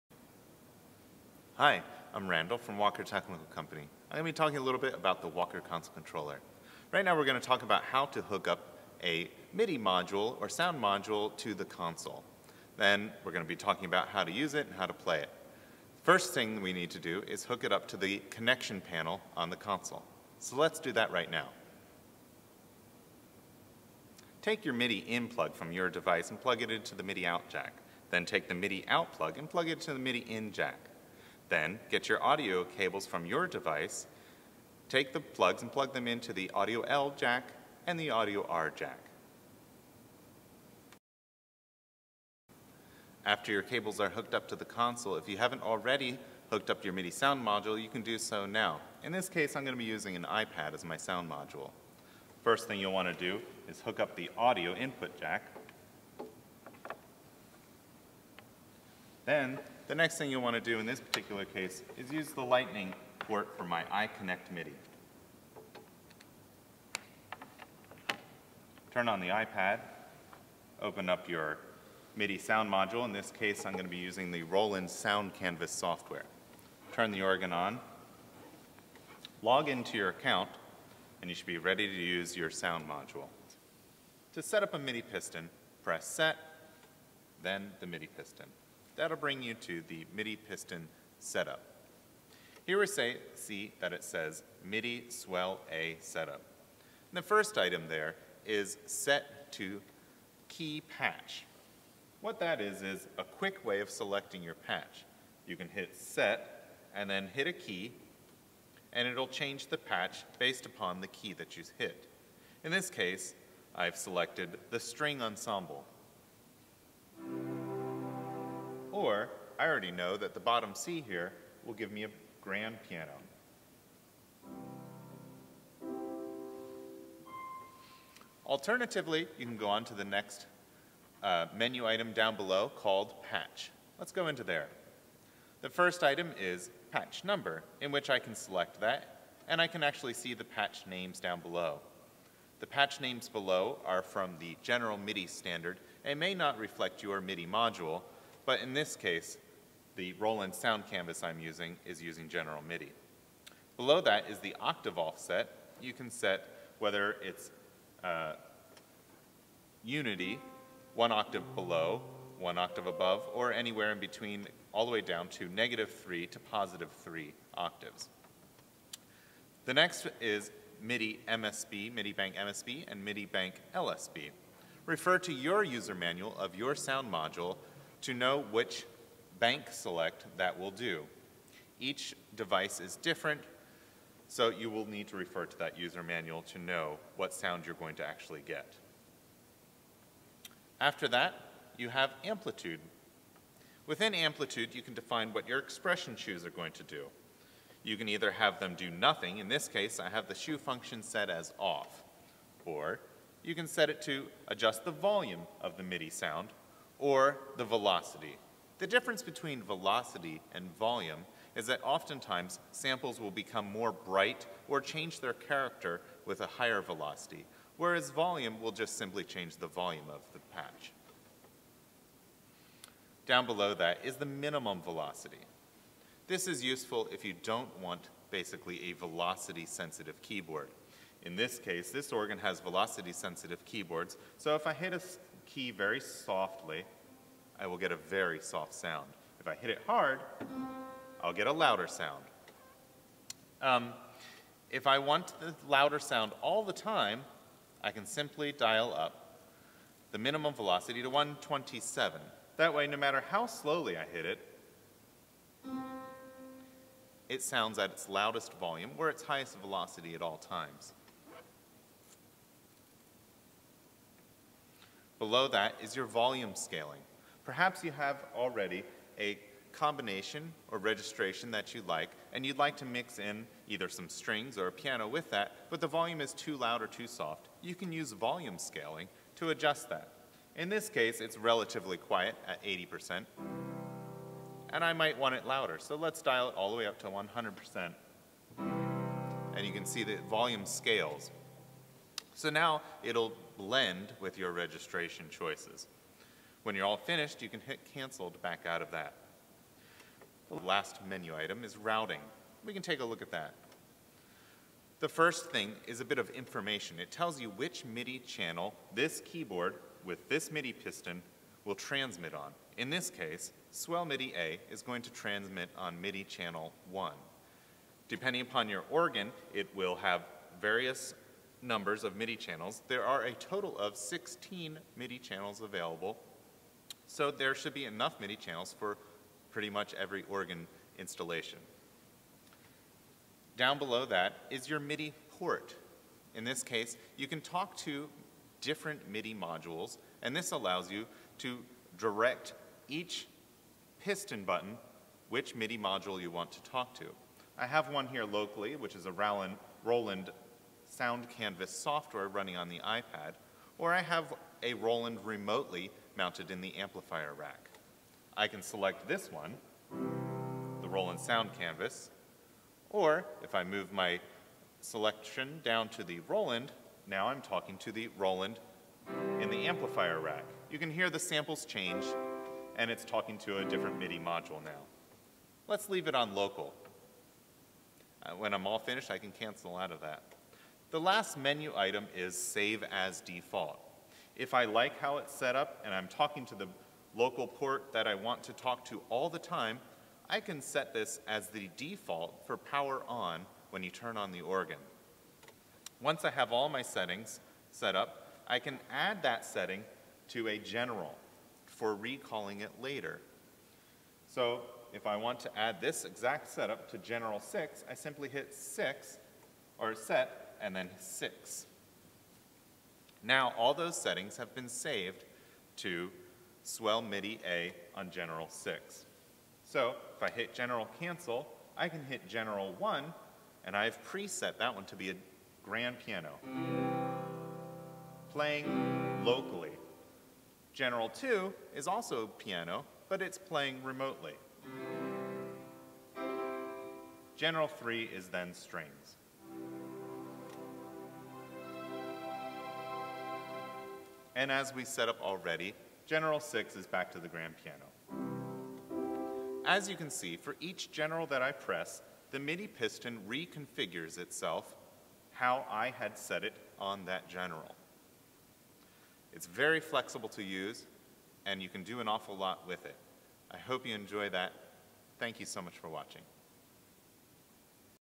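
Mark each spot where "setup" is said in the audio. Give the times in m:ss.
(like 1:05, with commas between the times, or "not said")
1:31, 1:35, 6:46.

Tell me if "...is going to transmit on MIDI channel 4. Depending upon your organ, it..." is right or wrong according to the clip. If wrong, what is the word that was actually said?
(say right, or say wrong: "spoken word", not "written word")
wrong: "1", not "4".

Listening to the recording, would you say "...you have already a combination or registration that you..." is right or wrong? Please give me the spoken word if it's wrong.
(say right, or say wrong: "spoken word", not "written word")
right.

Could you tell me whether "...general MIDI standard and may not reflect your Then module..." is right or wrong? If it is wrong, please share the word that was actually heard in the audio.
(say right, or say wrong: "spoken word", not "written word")
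wrong: "MIDI", not "Then".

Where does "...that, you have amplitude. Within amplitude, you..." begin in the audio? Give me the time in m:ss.
3:11.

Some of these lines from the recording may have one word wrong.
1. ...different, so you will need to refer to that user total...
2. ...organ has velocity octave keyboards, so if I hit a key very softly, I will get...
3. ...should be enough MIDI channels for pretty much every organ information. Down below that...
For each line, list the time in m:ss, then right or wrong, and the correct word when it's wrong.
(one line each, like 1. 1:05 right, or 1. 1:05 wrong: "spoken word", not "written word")
1. 3:02 wrong: "manual", not "total"
2. 3:52 wrong: "sensitive", not "octave"
3. 5:27 wrong: "installation", not "information".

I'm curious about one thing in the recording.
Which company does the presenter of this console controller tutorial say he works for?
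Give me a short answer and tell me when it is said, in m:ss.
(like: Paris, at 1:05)
Walker Technical Company, at 0:02.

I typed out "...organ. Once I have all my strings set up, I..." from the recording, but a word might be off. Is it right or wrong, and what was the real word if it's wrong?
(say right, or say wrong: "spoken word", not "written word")
wrong: "settings", not "strings".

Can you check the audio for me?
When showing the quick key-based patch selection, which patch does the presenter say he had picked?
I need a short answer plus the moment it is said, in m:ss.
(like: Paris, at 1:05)
string ensemble, at 1:54.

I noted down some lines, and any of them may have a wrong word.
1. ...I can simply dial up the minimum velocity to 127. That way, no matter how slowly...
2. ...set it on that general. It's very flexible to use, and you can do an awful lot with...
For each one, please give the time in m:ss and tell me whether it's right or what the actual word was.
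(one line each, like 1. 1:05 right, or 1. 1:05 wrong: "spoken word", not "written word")
1. 4:07 right
2. 7:36 right.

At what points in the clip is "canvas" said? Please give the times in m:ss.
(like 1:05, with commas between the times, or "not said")
1:15, 2:30, 5:51, 6:01.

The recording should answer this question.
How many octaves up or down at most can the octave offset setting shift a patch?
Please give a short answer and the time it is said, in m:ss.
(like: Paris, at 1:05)
3, at 2:46.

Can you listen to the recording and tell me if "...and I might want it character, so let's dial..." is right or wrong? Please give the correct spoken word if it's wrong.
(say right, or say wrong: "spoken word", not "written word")
wrong: "louder", not "character".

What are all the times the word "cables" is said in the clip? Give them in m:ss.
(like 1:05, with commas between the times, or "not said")
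0:32, 0:43.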